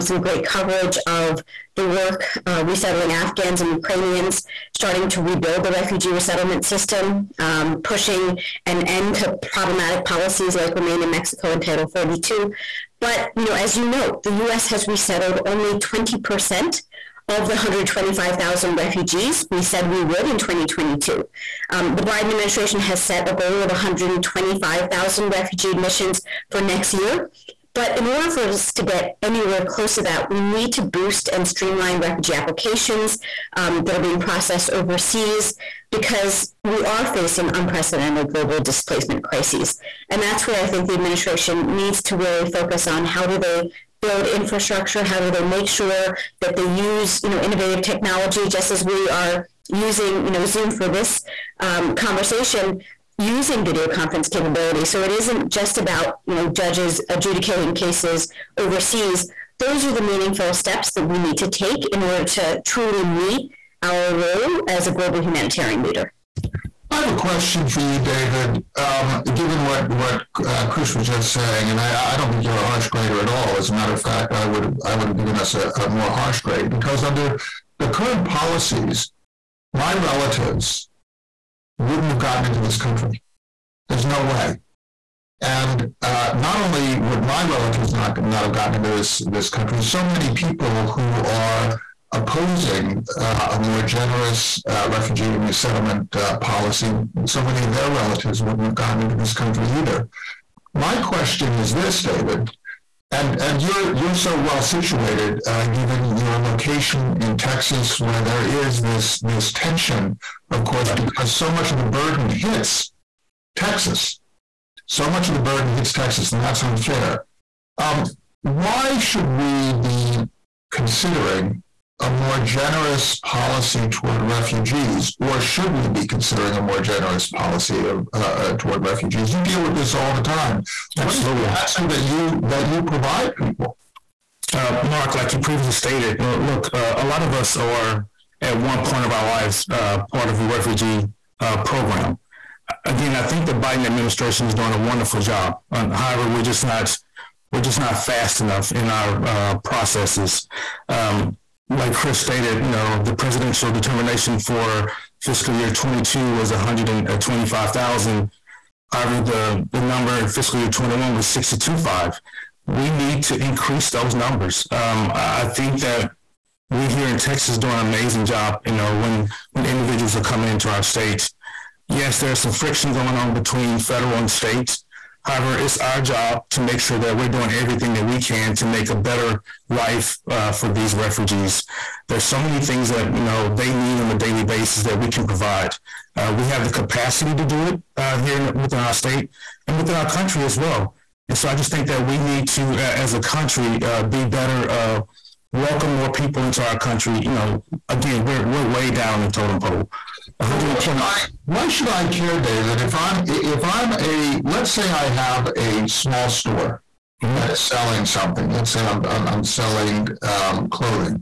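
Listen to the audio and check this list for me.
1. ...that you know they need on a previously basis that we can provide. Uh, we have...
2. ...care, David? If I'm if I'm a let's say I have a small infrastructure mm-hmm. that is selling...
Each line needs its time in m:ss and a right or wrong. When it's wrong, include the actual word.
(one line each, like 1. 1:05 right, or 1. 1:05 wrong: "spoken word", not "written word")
1. 3:02 wrong: "daily", not "previously"
2. 3:22 wrong: "store", not "infrastructure".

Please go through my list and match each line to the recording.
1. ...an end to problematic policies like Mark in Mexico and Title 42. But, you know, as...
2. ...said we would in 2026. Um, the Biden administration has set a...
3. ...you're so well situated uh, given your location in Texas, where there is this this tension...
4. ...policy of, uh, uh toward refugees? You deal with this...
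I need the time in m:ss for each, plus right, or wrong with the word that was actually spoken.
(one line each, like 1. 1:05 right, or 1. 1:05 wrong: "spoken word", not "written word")
1. 0:08 wrong: "Remain", not "Mark"
2. 0:19 wrong: "2022", not "2026"
3. 1:43 right
4. 2:07 right.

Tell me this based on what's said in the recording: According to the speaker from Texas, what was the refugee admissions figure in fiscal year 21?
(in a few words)
62.5.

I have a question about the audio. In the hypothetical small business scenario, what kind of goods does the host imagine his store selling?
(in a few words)
Clothing.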